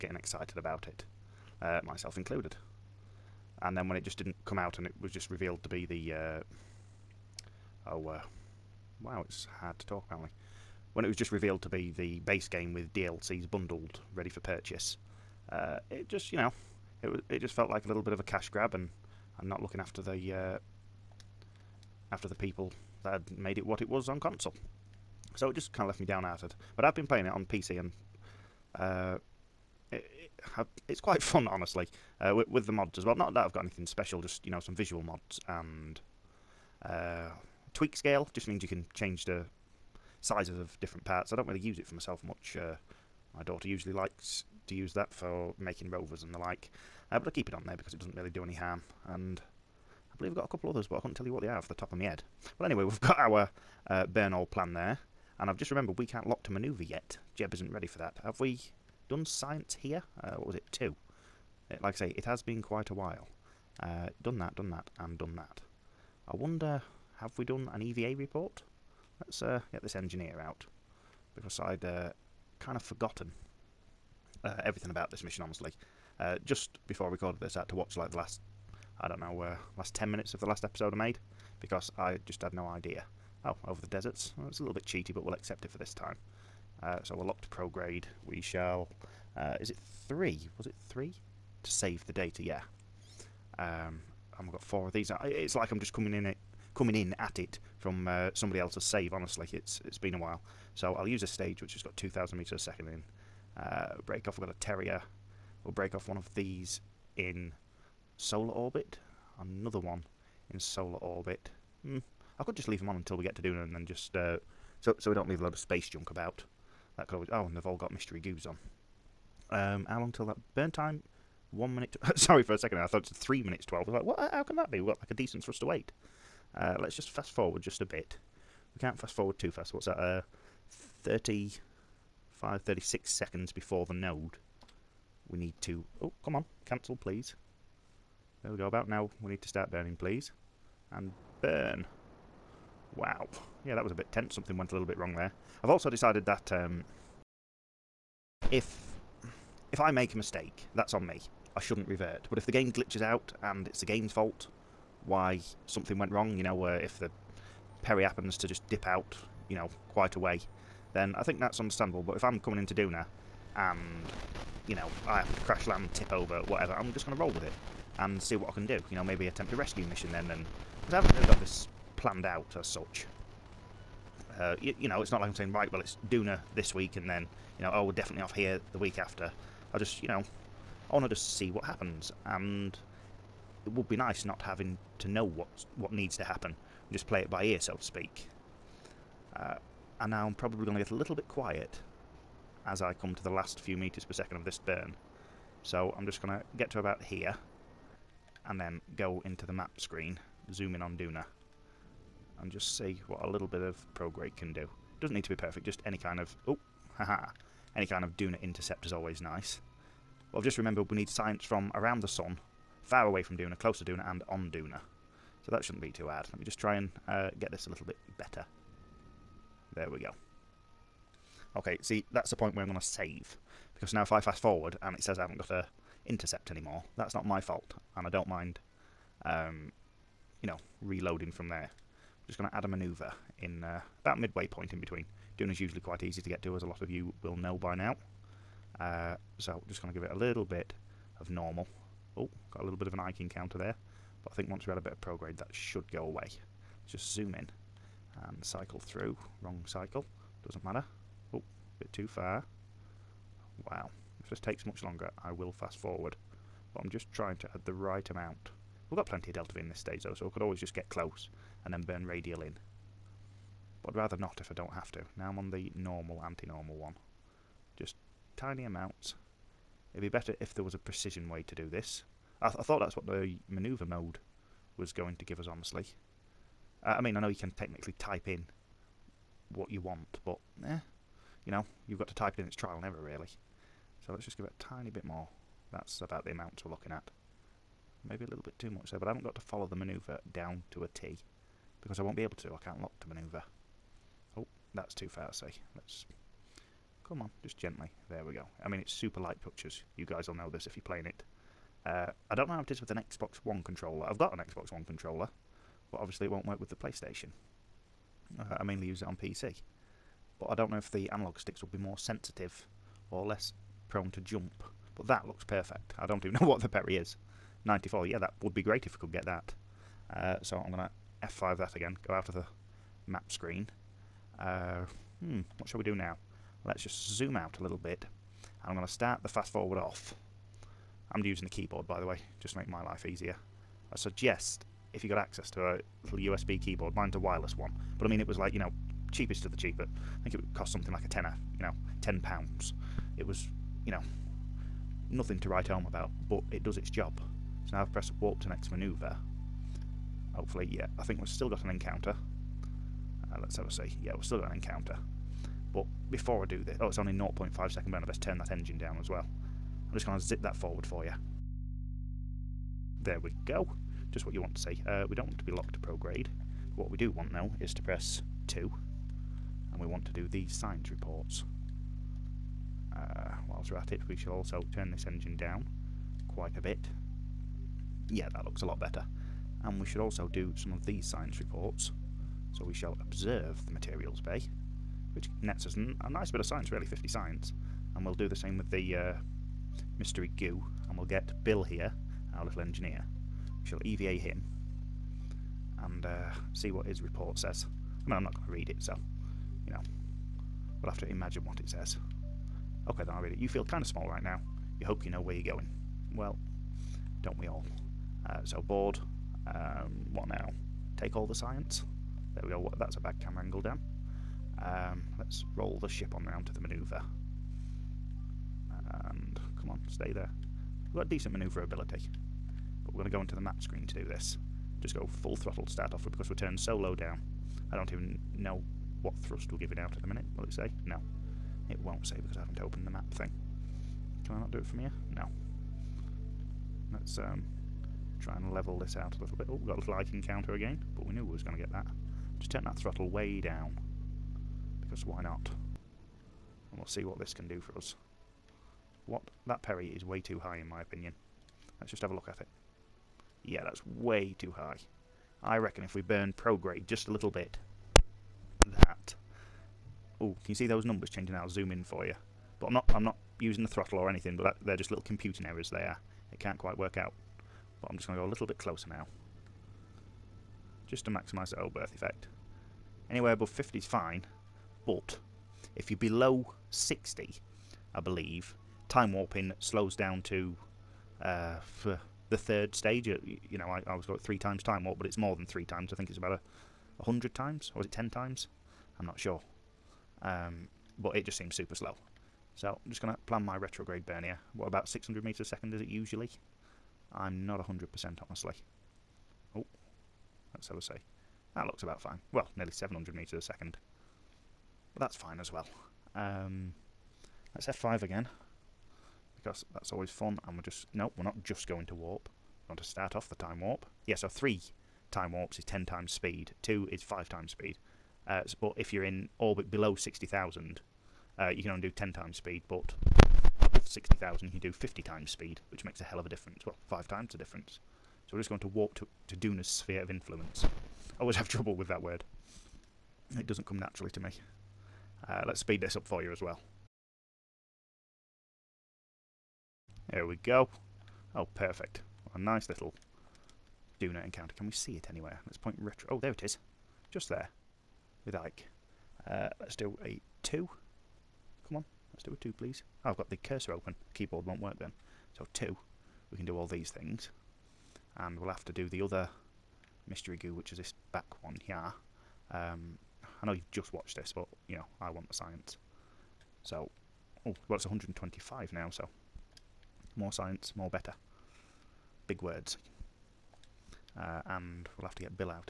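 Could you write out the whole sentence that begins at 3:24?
Doesn't need to be perfect, just any kind of...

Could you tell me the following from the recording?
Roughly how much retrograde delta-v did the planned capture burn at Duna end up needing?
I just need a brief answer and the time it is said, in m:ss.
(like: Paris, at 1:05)
nearly 700 meters a second, at 8:22.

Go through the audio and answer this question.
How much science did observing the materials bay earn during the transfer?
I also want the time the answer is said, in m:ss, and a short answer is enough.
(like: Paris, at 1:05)
50, at 6:26.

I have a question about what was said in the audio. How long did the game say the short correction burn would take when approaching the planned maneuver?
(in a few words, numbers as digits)
0.5 second.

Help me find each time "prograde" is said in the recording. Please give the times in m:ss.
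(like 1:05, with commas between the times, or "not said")
1:27, 3:23, 4:05, 6:05, 7:36.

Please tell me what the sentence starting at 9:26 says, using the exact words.
So, oh, well, it's 125 now, so more science, more better.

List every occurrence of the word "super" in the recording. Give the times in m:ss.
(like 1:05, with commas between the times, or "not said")
4:58, 8:11.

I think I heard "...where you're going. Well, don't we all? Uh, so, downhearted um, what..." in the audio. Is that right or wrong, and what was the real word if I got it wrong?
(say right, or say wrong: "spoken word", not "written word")
wrong: "bored", not "downhearted".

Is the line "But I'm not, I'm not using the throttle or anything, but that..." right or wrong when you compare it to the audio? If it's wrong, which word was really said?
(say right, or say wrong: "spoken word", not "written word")
right.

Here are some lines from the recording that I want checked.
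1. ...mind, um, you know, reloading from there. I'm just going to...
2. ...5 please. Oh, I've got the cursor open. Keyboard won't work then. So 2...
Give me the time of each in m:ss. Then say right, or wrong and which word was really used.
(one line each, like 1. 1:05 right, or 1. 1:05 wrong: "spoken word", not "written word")
1. 3:48 right
2. 9:12 wrong: "2", not "5".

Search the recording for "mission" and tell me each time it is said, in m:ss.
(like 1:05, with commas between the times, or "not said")
1:15, 2:49.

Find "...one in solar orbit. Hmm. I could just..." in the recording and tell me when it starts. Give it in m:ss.
1:49.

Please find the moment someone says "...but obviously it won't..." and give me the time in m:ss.
5:05.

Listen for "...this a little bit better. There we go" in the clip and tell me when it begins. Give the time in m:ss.
3:37.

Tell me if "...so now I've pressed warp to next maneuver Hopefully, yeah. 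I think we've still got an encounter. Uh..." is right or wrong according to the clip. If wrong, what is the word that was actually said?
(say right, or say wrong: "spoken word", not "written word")
right.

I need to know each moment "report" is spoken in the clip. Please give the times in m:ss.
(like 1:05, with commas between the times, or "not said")
1:08, 6:10, 6:21, 6:36.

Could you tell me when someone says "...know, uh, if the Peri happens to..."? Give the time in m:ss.
2:36.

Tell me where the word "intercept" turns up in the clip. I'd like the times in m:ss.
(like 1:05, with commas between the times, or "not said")
3:28, 3:46.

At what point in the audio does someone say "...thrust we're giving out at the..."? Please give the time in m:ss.
7:09.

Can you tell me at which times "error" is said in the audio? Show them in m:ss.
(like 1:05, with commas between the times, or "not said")
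4:42, 7:45.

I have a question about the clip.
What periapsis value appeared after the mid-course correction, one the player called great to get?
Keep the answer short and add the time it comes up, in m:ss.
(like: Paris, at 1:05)
94, at 5:17.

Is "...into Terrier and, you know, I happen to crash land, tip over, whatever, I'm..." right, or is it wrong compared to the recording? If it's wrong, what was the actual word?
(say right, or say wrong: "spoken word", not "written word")
wrong: "Duna", not "Terrier".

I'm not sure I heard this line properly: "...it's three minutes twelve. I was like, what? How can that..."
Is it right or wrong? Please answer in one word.
right.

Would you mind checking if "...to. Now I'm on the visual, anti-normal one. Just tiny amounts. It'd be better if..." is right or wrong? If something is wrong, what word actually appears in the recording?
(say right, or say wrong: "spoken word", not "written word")
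wrong: "normal", not "visual".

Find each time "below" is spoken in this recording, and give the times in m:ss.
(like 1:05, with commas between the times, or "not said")
7:55, 8:39.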